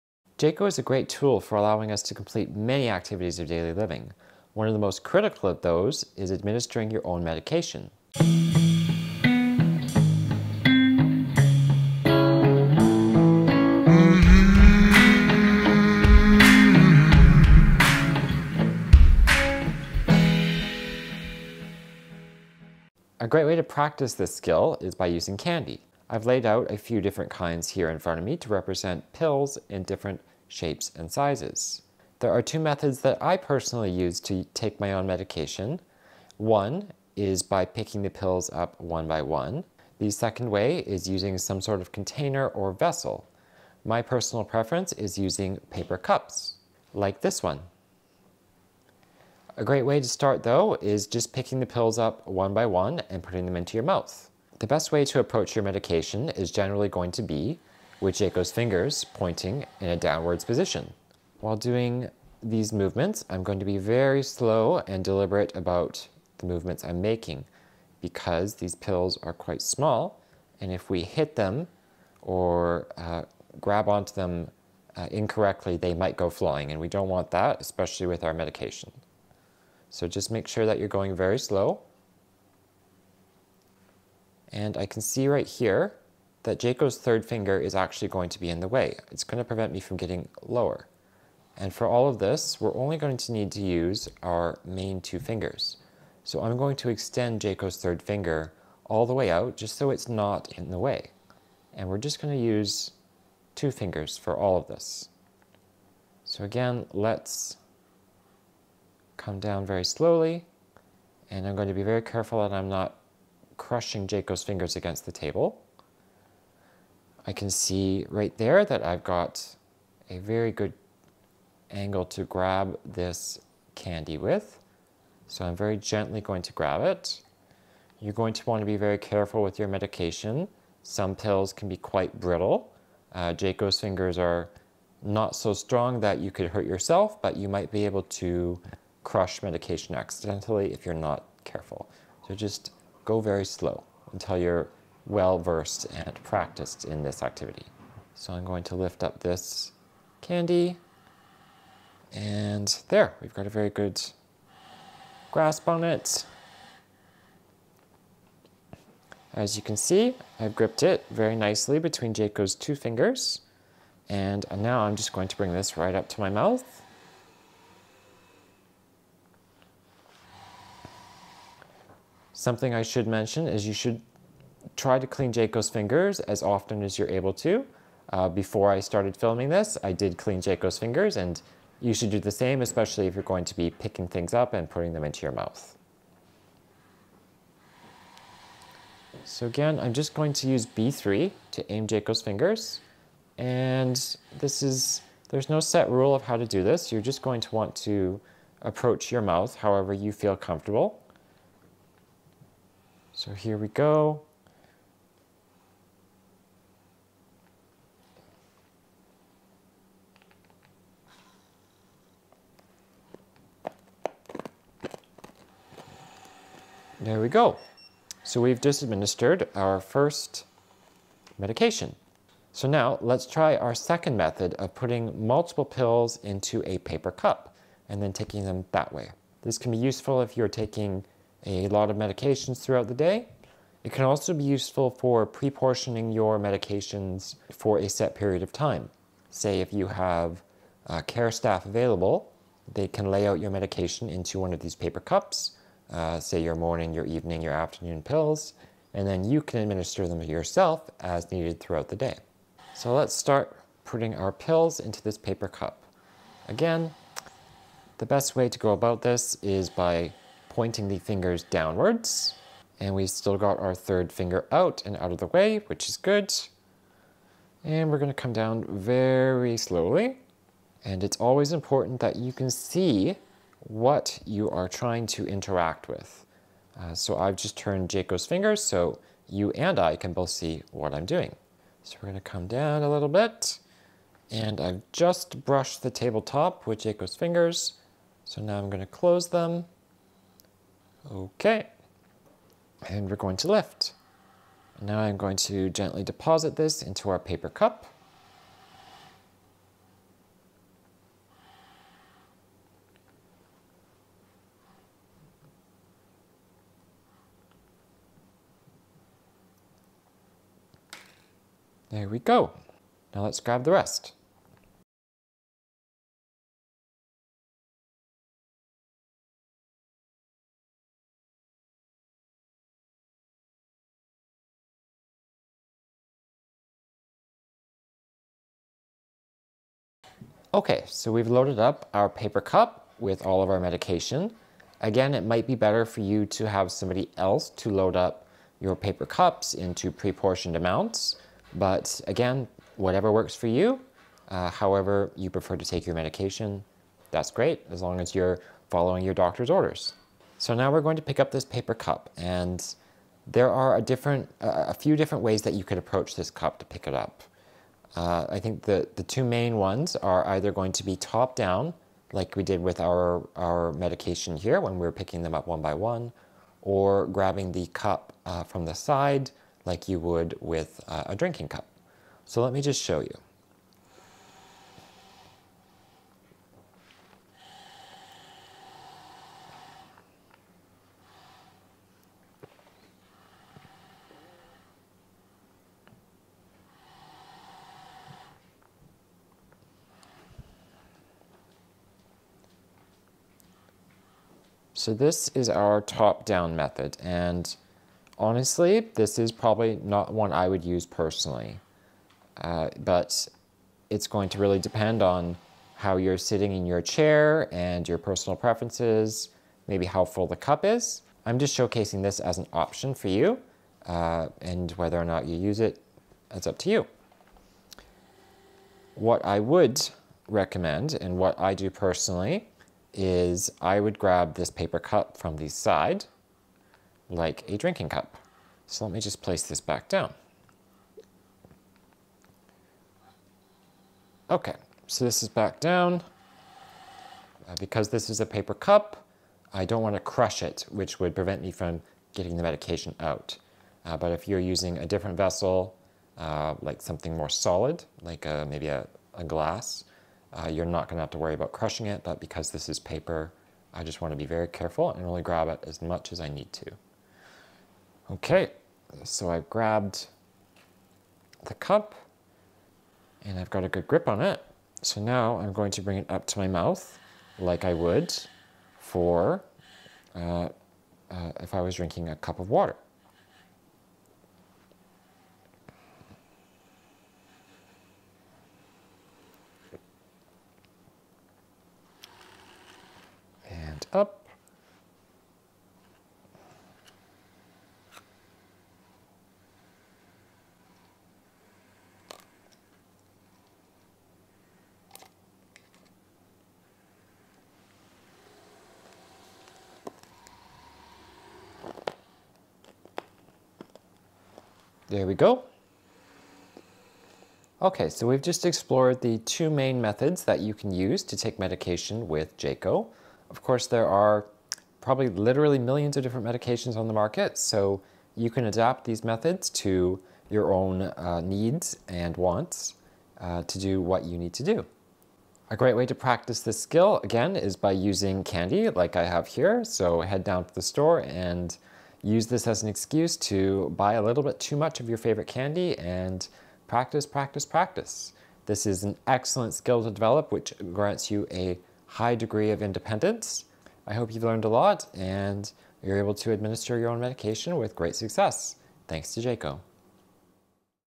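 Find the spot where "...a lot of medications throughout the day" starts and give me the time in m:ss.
3:51.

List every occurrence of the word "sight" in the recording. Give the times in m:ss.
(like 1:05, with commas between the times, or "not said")
not said.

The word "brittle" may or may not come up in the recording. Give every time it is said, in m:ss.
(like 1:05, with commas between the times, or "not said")
2:12.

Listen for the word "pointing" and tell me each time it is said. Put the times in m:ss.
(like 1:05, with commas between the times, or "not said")
0:59, 4:20.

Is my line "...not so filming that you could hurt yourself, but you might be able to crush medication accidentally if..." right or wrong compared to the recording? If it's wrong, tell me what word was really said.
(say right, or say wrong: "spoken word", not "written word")
wrong: "strong", not "filming".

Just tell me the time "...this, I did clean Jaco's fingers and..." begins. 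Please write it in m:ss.
2:59.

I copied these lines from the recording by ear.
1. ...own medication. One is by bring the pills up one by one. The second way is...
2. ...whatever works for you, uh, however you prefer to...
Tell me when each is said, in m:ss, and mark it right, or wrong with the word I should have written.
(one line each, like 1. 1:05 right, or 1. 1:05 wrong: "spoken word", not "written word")
1. 0:34 wrong: "picking", not "bring"
2. 5:42 right.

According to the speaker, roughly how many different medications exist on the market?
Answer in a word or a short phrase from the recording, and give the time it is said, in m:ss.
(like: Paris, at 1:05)
millions, at 8:35.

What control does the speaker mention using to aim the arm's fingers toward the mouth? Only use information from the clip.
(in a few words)
B3.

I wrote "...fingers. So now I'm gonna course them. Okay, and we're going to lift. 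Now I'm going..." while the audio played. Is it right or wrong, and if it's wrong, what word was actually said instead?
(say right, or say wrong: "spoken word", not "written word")
wrong: "close", not "course".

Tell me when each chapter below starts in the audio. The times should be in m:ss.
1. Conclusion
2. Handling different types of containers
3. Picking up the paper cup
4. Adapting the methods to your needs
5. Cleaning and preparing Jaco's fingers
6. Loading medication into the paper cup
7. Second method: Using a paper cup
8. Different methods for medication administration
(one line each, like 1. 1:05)
1. 9:04
2. 7:09
3. 5:50
4. 8:33
5. 2:58
6. 4:58
7. 3:42
8. 1:01.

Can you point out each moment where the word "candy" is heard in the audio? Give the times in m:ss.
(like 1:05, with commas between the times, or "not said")
0:25, 2:03, 2:30, 8:48, 8:55.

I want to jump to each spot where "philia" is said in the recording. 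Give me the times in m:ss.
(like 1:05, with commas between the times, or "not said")
not said.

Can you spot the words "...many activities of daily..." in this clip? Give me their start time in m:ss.
0:02.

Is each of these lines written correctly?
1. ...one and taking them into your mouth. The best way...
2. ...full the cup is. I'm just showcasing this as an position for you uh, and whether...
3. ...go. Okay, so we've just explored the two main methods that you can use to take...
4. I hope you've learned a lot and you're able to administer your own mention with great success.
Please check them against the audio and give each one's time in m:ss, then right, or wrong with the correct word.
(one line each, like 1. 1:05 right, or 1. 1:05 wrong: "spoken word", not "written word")
1. 0:52 wrong: "putting", not "taking"
2. 6:50 wrong: "option", not "position"
3. 8:25 right
4. 9:03 wrong: "medication", not "mention".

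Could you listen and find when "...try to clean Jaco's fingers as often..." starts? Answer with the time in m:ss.
2:54.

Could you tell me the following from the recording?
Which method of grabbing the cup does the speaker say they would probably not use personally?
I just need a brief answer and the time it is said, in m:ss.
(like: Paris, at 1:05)
top-down method, at 6:35.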